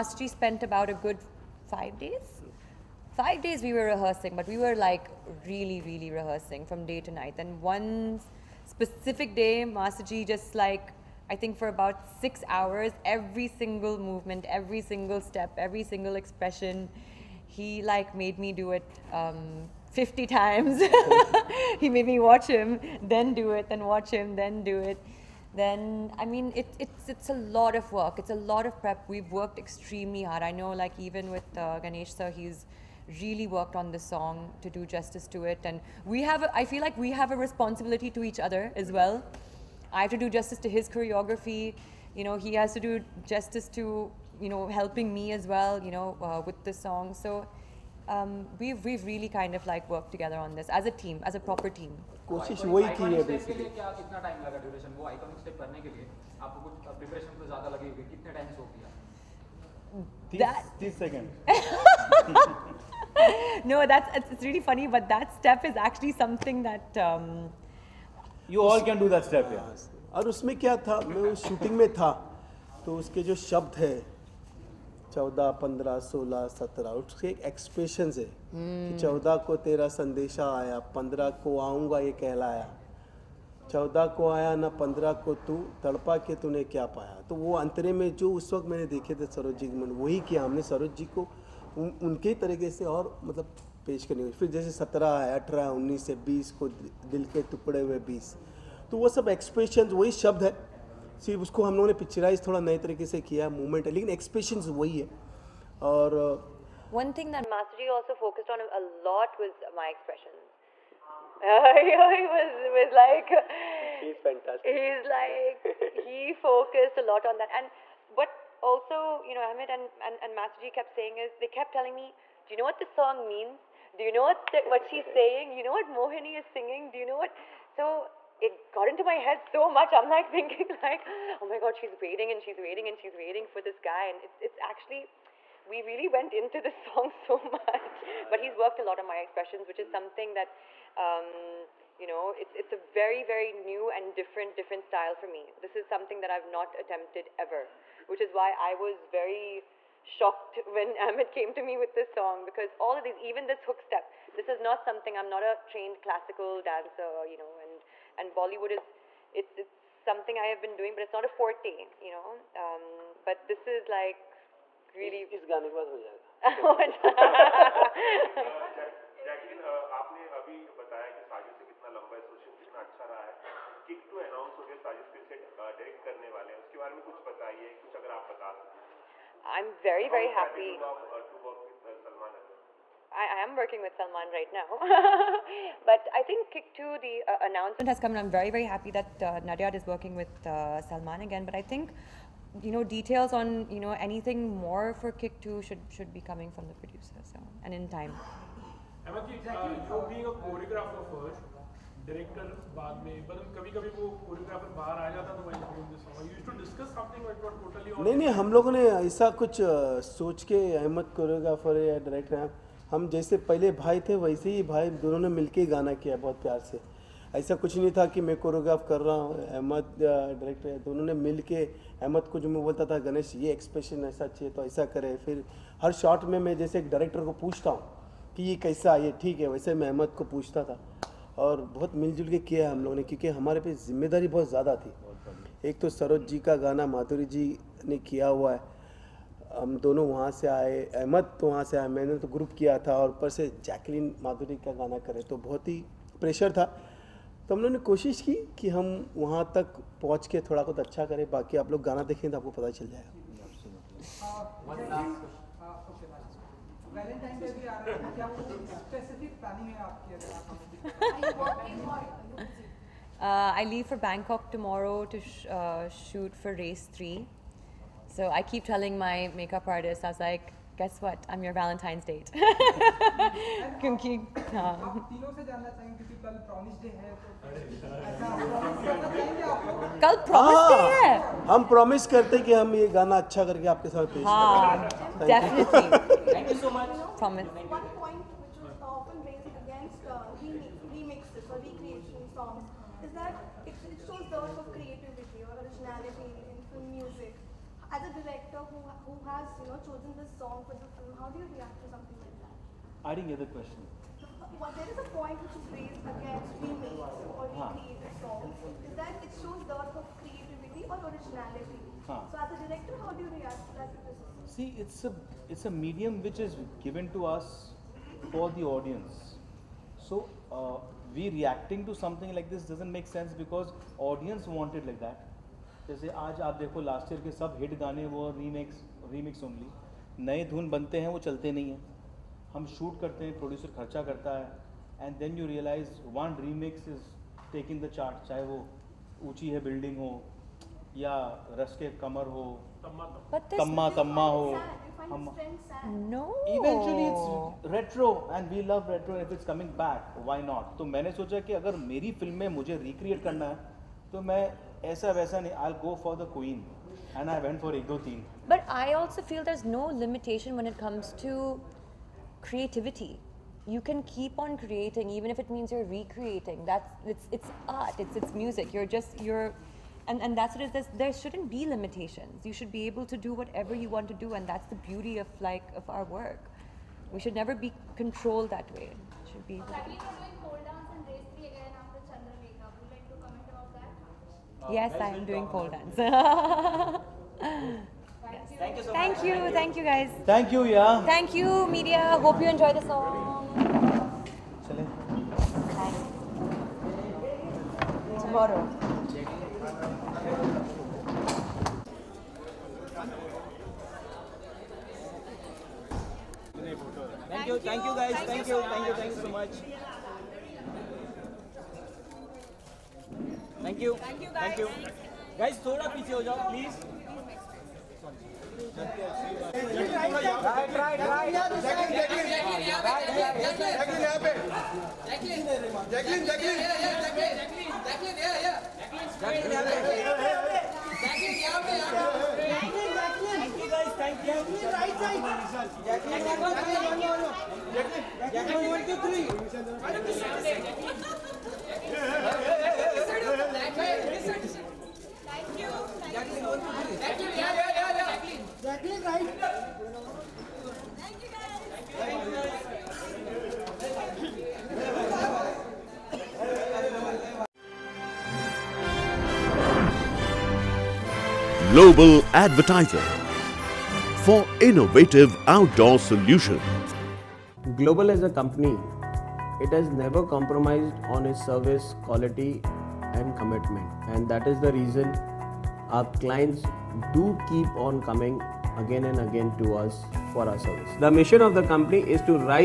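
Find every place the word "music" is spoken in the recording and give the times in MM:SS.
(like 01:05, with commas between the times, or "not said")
06:08.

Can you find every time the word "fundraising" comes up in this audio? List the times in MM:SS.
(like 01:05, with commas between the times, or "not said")
not said.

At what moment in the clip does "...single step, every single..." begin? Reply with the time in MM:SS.
00:14.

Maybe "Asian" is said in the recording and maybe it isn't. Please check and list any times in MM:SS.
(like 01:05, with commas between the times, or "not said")
not said.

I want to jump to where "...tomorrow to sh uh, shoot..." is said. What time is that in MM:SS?
04:24.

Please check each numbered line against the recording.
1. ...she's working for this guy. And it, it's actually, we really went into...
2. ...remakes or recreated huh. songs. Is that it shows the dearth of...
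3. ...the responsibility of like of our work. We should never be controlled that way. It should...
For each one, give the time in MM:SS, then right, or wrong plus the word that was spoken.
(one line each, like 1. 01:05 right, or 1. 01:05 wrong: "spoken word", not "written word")
1. 02:12 wrong: "waiting", not "working"
2. 05:06 right
3. 06:14 wrong: "beauty", not "responsibility".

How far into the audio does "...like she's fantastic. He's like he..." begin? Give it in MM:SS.
01:52.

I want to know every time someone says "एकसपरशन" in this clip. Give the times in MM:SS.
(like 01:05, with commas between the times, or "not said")
01:17, 01:39, 01:44, 03:43.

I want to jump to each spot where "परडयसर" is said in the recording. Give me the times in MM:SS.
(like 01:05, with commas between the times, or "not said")
05:33.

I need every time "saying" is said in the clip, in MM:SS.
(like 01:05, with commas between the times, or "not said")
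02:00, 02:05.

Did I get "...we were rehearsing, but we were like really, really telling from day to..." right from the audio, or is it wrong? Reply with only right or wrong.
wrong.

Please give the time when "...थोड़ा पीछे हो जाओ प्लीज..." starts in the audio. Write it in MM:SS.
06:55.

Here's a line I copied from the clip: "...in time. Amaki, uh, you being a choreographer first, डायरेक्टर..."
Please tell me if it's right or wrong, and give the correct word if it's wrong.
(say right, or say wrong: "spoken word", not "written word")
right.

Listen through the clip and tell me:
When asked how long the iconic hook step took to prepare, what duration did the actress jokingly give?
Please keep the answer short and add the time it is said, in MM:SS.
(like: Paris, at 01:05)
30 seconds, at 01:00.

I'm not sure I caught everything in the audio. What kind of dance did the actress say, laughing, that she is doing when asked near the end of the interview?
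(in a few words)
Pole dance.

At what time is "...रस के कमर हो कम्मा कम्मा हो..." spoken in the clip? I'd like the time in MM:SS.
05:41.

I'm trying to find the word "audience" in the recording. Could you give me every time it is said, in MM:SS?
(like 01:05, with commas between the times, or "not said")
05:18, 05:24.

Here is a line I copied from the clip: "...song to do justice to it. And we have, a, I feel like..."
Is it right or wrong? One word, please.
right.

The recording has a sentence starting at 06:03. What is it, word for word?
You can keep on creating, even if it means you're recreating.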